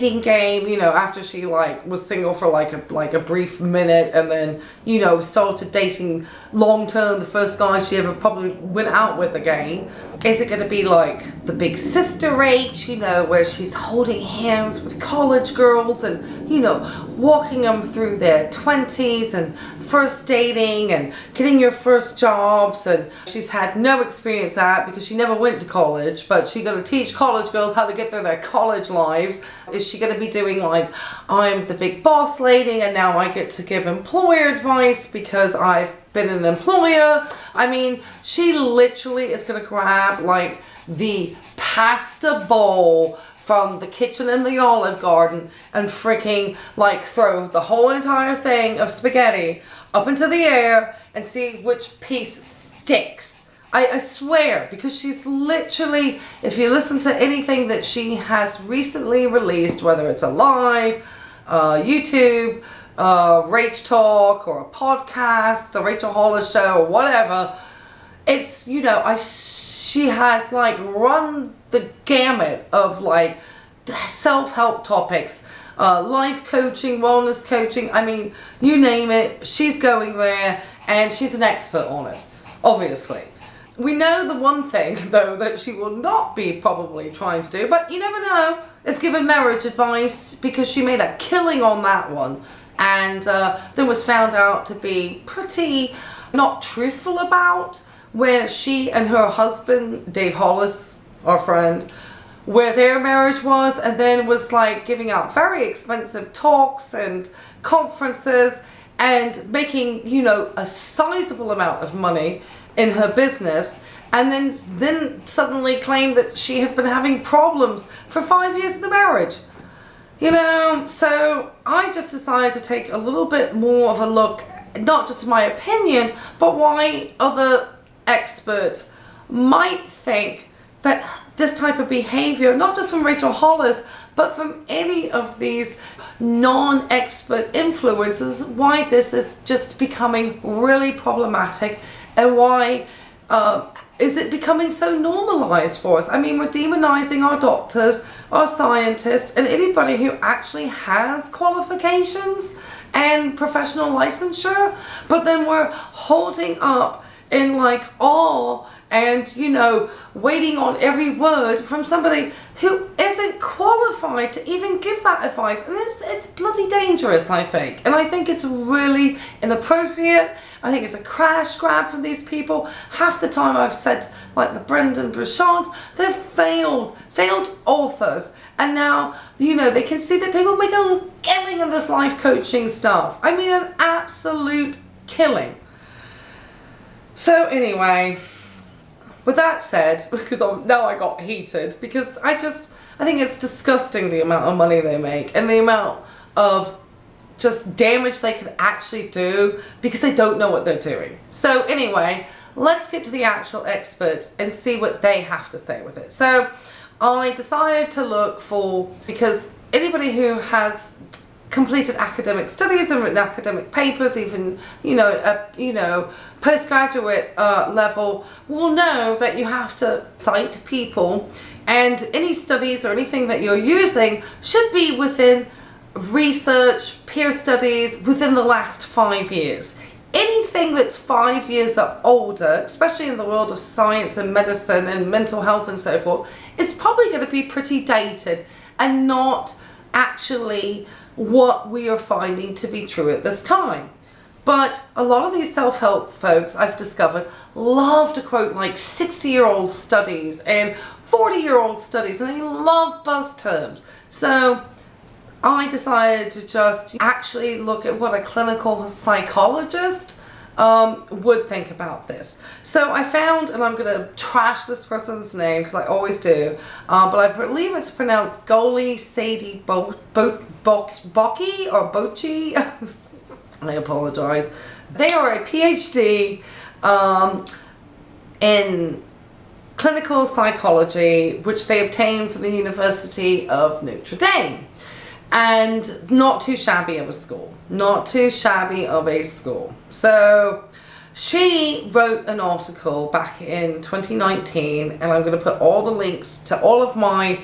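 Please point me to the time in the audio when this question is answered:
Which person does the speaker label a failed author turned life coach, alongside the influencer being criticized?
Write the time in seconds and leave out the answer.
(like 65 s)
174 s.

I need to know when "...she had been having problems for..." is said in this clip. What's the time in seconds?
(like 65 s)
116 s.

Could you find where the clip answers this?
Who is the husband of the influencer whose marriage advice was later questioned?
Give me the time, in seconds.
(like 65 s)
100 s.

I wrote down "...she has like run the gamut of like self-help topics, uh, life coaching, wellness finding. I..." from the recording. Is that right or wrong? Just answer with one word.
wrong.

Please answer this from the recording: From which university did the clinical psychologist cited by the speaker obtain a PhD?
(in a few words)
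University of Notre Dame.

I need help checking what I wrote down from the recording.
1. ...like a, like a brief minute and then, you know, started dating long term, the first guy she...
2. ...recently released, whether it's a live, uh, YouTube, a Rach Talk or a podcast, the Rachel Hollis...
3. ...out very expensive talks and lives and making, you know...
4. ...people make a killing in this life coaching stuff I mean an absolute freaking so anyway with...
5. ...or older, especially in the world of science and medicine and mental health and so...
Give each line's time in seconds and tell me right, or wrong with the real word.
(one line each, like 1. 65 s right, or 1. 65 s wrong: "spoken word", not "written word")
1. 2 s right
2. 58 s right
3. 105 s wrong: "conferences", not "lives"
4. 180 s wrong: "killing", not "freaking"
5. 231 s right.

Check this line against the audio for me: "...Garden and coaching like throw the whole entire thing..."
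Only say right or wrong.
wrong.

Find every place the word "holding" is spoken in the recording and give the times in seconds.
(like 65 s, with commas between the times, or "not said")
13 s, 155 s.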